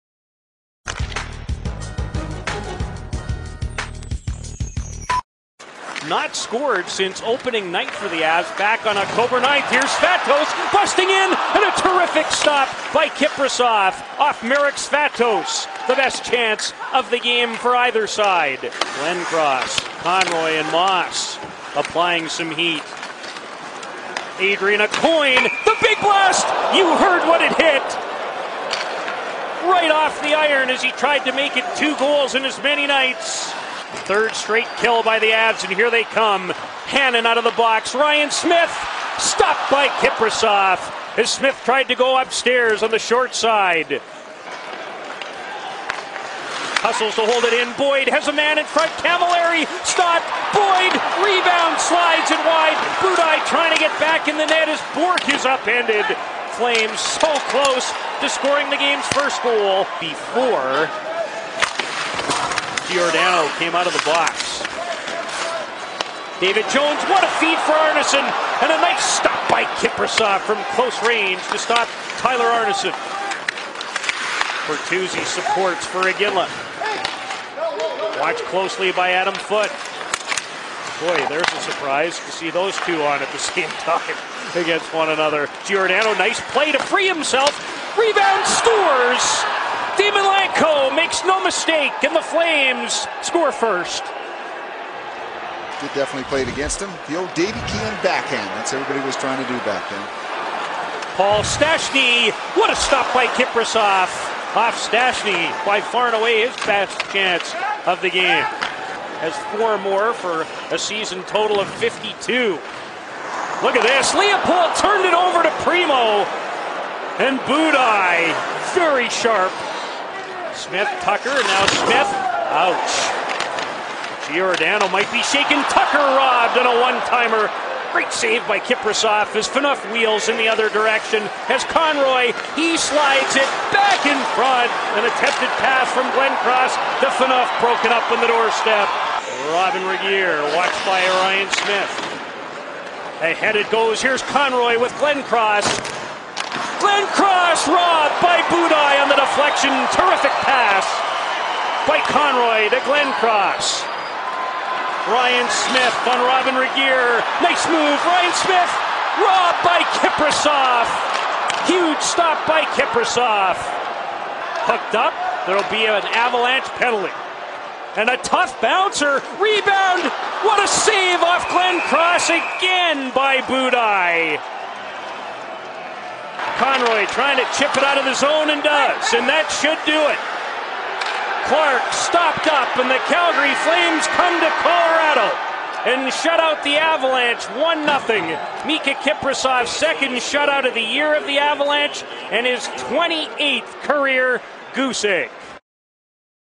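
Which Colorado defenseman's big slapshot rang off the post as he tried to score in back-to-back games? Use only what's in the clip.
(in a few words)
Adrian Aucoin.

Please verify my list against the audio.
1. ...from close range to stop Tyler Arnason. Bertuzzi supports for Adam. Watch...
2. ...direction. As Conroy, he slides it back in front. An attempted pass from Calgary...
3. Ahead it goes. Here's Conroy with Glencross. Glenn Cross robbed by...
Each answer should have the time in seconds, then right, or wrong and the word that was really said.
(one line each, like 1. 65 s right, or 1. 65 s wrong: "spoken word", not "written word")
1. 70 s wrong: "Iginla", not "Adam"
2. 130 s wrong: "Glencross", not "Calgary"
3. 143 s right.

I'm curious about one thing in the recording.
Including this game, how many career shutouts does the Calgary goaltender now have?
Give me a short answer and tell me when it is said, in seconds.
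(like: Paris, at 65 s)
28, at 192 s.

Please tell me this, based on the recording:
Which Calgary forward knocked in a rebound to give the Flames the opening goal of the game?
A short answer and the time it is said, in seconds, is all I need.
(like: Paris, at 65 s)
Daymond Langkow, at 89 s.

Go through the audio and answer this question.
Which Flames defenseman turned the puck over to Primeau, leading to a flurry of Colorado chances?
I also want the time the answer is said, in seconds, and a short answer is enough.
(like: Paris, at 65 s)
Leopold, at 114 s.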